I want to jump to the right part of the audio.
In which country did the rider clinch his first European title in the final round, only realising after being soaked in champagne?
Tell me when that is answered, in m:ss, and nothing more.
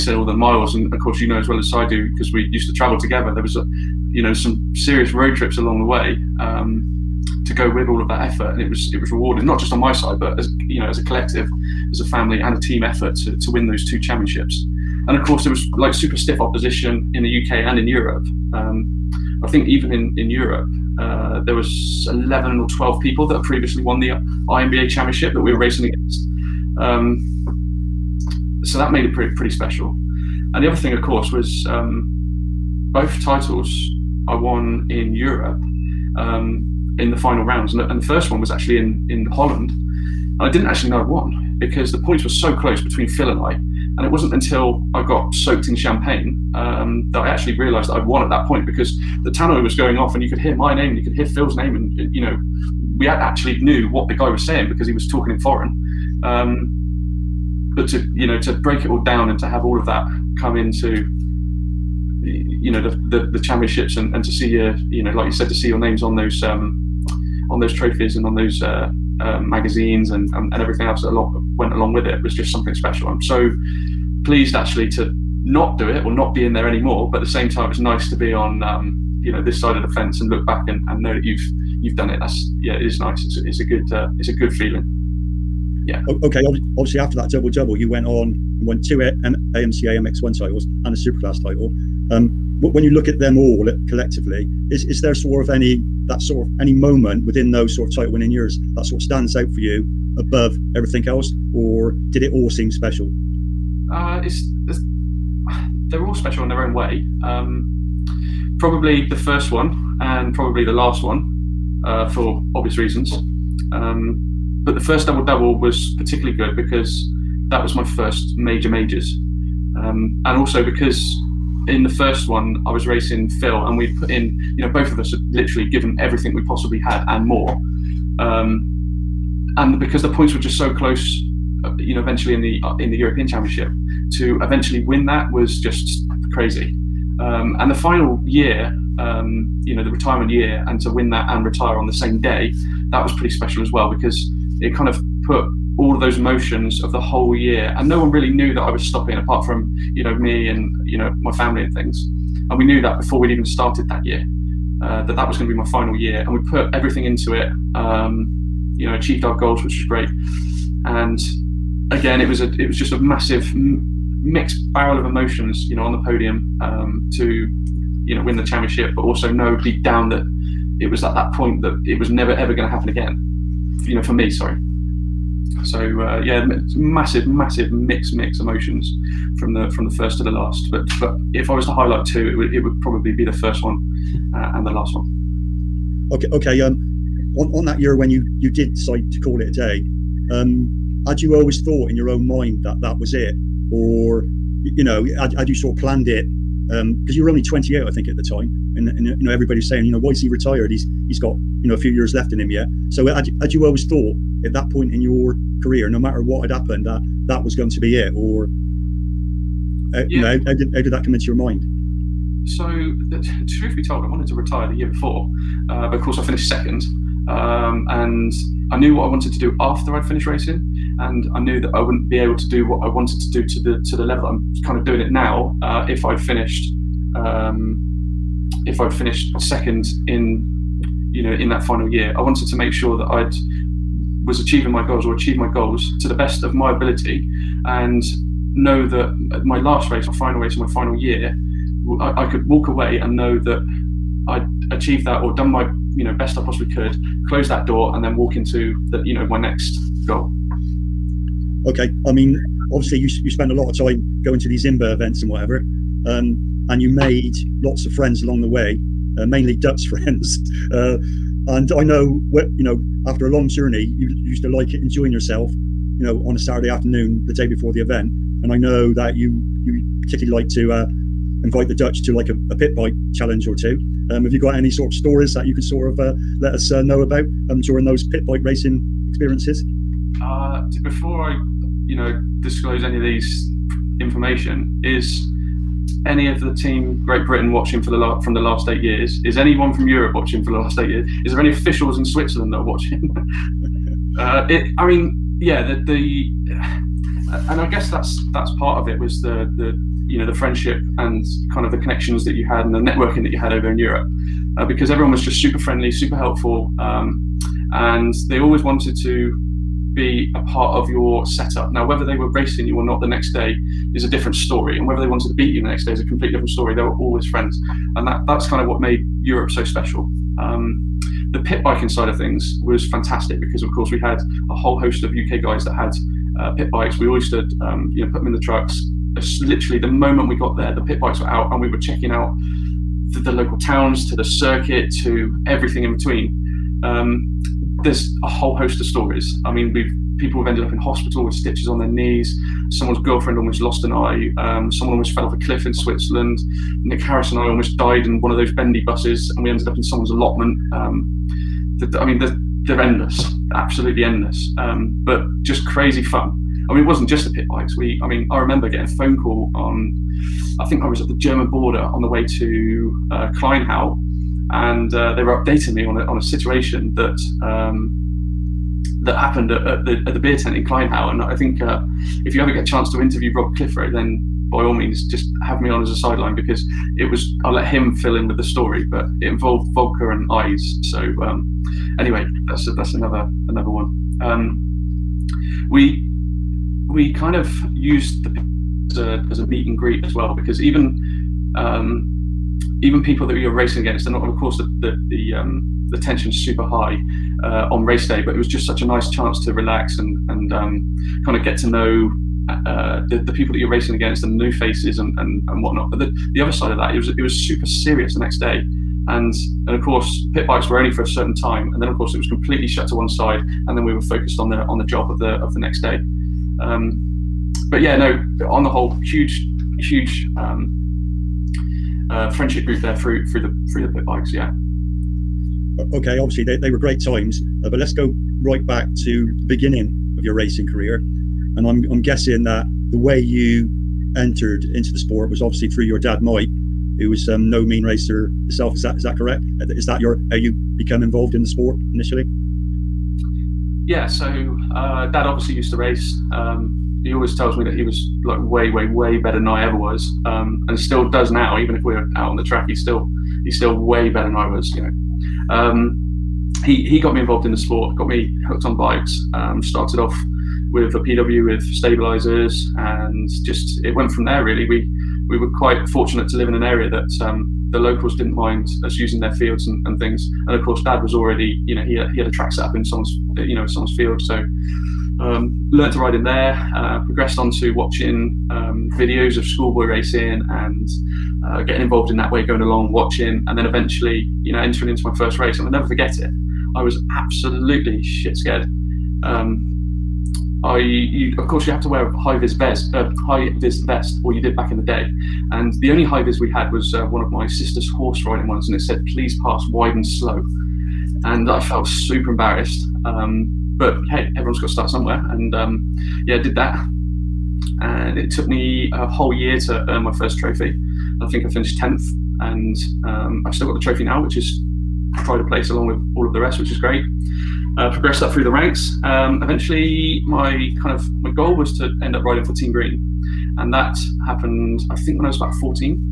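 0:39.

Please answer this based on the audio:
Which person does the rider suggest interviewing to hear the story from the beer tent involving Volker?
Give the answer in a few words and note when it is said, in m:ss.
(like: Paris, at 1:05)
Rob Clifford, at 6:13.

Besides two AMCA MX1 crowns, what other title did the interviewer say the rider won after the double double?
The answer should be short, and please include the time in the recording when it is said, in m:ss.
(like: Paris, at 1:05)
Superclass, at 1:30.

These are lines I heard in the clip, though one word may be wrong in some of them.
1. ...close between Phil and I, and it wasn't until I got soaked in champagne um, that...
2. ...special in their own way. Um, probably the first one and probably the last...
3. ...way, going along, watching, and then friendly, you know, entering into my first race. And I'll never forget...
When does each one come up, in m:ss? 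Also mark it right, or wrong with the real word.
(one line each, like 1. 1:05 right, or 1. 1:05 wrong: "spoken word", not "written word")
1. 0:42 right
2. 1:46 right
3. 8:02 wrong: "eventually", not "friendly".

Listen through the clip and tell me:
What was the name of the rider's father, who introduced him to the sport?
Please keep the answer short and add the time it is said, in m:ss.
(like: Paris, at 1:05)
Mike, at 7:16.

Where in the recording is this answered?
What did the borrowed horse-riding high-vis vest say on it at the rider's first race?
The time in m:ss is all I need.
8:19.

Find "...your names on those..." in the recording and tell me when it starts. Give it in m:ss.
1:05.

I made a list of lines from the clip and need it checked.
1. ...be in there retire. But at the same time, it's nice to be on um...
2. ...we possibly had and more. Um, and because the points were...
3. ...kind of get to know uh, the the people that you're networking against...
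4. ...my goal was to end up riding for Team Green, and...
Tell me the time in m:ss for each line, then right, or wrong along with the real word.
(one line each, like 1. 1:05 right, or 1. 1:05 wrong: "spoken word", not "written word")
1. 1:16 wrong: "anymore", not "retire"
2. 2:06 right
3. 6:41 wrong: "racing", not "networking"
4. 8:41 right.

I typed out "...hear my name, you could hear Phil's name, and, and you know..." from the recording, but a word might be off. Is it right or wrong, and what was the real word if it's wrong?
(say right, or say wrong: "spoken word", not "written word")
right.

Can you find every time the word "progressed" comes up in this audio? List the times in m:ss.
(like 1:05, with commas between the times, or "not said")
7:56, 8:37.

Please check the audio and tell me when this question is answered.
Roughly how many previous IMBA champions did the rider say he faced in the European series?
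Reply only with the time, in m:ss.
0:22.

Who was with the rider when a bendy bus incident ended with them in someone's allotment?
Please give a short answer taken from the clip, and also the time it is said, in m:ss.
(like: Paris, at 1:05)
Nick Harris, at 5:46.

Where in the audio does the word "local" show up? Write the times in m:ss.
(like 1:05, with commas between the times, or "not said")
5:33, 7:47.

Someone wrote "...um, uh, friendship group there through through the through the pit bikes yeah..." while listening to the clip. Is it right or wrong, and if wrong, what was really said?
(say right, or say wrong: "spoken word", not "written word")
right.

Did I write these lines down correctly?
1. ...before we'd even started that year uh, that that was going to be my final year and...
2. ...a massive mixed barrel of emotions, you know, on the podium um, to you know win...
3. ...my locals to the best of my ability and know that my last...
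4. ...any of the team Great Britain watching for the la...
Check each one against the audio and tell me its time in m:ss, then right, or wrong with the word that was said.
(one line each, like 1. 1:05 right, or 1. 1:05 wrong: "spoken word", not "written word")
1. 2:32 right
2. 2:42 right
3. 3:55 wrong: "goals", not "locals"
4. 4:46 right.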